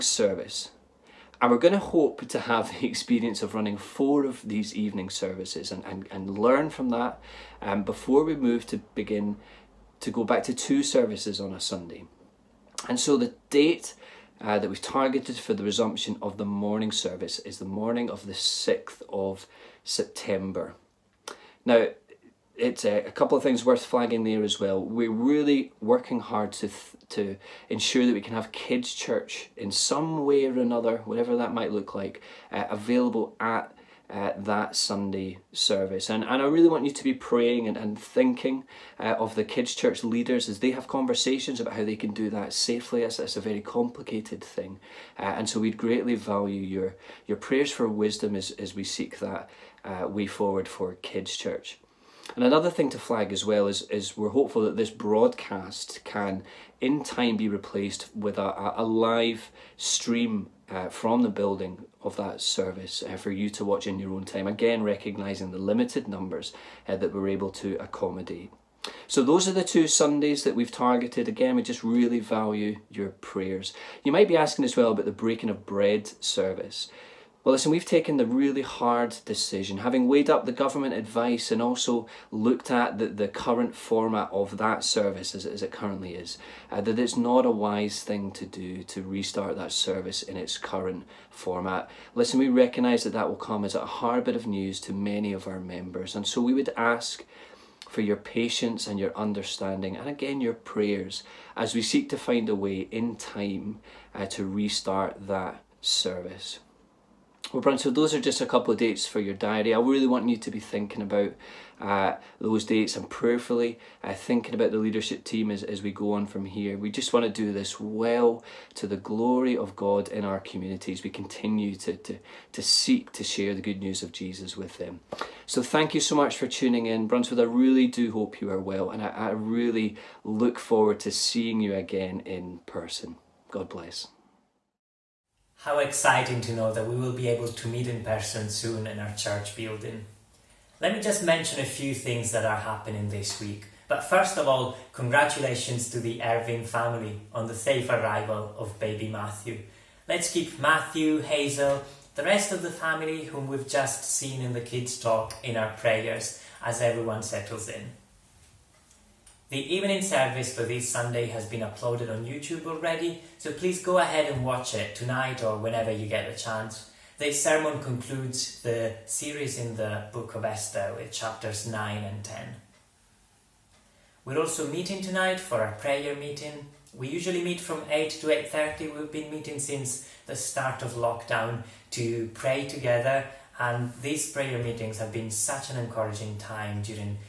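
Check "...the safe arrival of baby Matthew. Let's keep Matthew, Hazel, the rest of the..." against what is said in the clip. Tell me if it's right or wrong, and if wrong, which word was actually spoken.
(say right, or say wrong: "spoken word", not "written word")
right.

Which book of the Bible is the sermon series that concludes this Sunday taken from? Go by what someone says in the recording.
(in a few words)
Esther.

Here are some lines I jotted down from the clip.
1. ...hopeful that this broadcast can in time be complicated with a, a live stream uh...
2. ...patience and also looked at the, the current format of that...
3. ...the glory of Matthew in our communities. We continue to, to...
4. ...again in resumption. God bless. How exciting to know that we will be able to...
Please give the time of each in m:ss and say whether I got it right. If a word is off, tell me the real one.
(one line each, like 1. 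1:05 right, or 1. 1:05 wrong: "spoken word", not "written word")
1. 0:54 wrong: "replaced", not "complicated"
2. 1:20 wrong: "advice", not "patience"
3. 1:58 wrong: "God", not "Matthew"
4. 2:11 wrong: "person", not "resumption".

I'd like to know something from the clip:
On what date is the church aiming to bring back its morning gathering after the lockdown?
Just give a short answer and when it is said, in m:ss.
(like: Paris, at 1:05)
6th of September, at 0:18.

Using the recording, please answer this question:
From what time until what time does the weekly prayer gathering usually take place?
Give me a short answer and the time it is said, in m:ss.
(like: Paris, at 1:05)
8 to 8.30, at 2:57.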